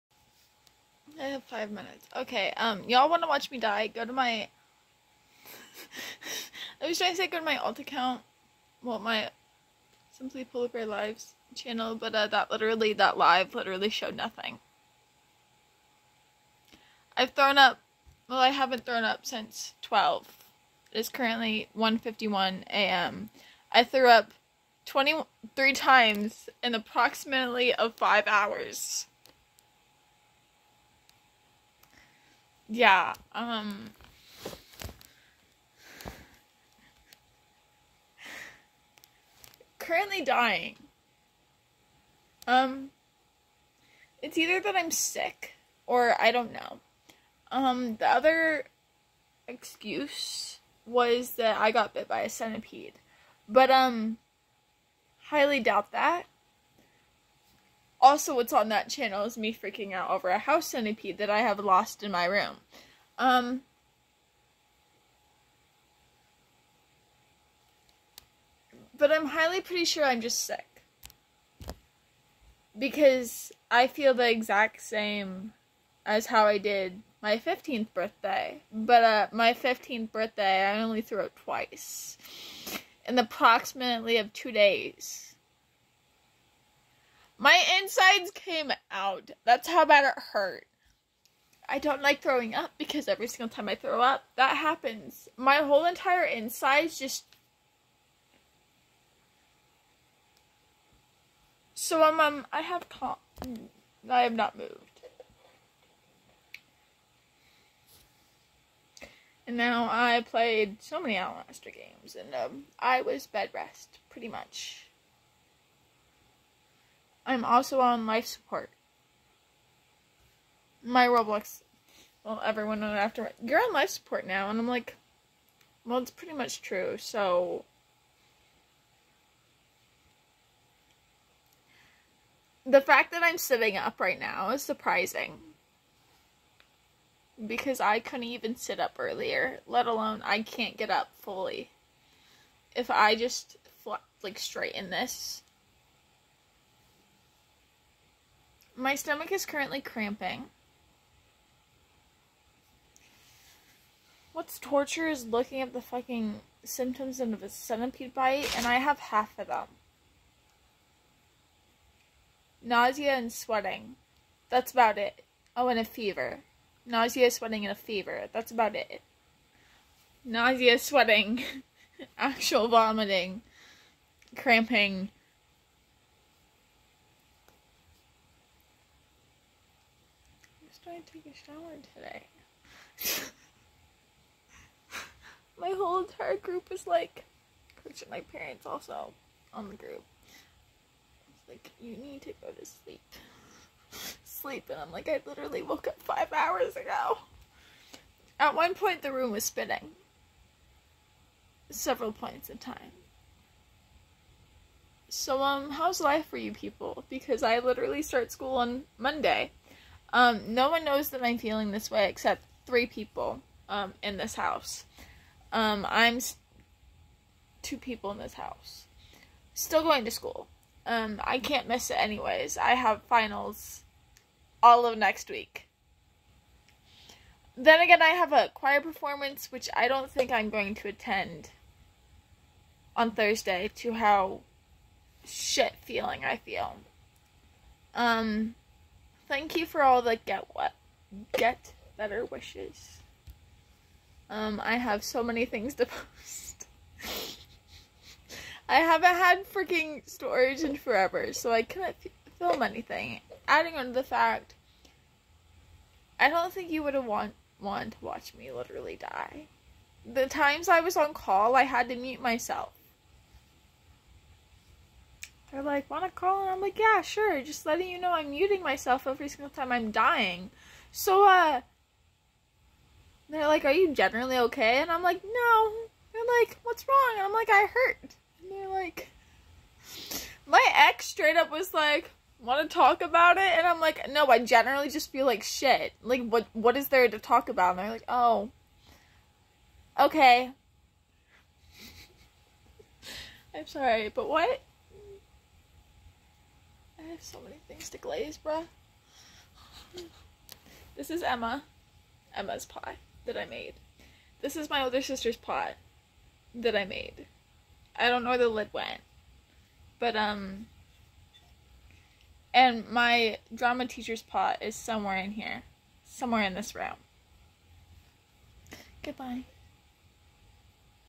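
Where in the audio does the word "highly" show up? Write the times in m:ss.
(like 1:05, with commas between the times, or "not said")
0:55, 1:09.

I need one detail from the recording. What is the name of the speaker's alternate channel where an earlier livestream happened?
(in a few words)
Simply Polar Bear Lives.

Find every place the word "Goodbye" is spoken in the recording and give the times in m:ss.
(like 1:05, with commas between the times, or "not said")
5:19.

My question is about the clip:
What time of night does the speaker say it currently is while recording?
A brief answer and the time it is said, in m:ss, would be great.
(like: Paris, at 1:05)
1:51 a.m., at 0:21.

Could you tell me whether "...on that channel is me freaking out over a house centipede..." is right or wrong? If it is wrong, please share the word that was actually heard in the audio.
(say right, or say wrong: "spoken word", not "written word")
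right.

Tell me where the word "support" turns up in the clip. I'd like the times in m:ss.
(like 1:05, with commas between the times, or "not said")
1:58, 2:03.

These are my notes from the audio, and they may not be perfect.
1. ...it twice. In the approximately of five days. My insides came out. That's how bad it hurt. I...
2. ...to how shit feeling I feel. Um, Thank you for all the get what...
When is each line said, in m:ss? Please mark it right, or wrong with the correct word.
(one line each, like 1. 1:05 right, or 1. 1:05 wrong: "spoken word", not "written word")
1. 1:21 wrong: "two", not "five"
2. 3:53 right.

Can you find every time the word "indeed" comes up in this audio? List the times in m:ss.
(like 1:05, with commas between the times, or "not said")
not said.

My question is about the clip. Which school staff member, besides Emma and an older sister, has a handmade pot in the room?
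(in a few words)
Drama teacher.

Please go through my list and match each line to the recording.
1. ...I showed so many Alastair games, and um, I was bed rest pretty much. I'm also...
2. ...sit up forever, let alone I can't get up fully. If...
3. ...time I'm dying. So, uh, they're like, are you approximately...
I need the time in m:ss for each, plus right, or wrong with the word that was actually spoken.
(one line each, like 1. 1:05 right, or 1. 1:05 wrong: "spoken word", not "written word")
1. 1:49 wrong: "played", not "showed"
2. 2:18 wrong: "earlier", not "forever"
3. 4:29 wrong: "generally", not "approximately".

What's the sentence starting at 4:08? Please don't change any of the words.
I haven't had freaking storage in forever, so I couldn't film anything.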